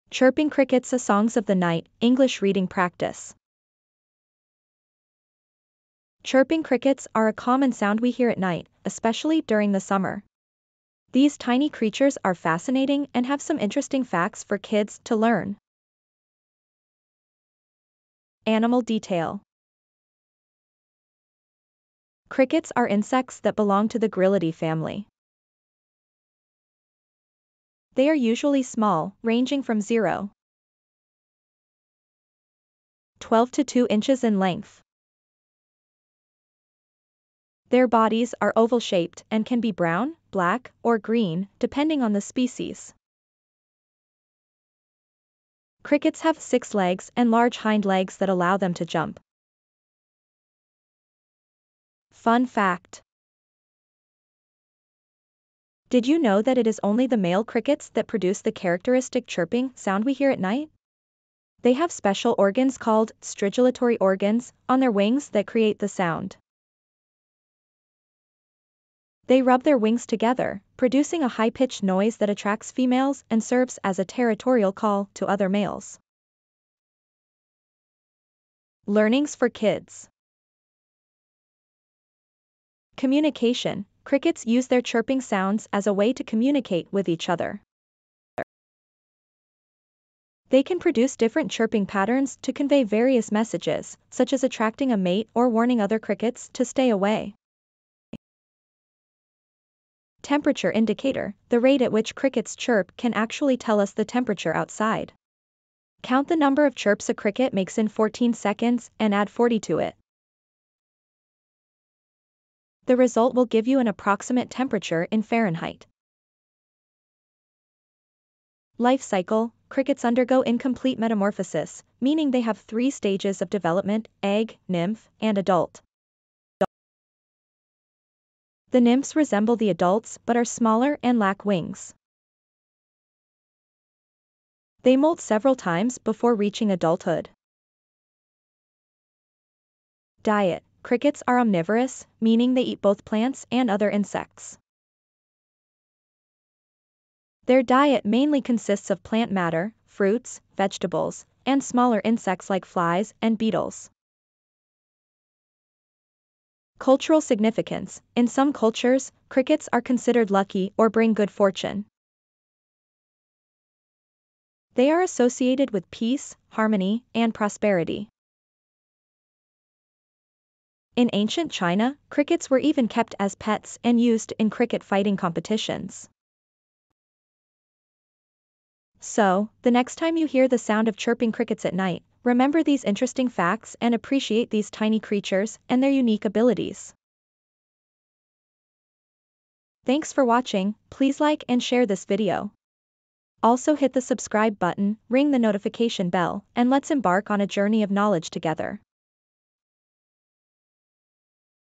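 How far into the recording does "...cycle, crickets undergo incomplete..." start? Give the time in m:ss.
1:59.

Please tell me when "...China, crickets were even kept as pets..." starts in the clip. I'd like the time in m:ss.
2:51.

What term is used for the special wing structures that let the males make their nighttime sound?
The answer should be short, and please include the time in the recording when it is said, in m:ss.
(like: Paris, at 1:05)
stridulatory organs, at 1:03.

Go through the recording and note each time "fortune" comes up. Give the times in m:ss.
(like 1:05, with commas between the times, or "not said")
2:41.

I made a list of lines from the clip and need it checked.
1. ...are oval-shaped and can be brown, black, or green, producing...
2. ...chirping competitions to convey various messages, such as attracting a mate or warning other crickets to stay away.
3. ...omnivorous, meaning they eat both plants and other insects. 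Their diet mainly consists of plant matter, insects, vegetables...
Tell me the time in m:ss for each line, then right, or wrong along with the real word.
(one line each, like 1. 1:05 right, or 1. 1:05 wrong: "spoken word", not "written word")
1. 0:38 wrong: "depending", not "producing"
2. 1:31 wrong: "patterns", not "competitions"
3. 2:21 wrong: "fruits", not "insects".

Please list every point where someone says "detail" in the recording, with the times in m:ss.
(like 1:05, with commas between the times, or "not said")
0:18.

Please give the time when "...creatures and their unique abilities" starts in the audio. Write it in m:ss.
3:04.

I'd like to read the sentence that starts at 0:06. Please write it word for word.
Chirping crickets are a common sound we hear at night, especially during the summer.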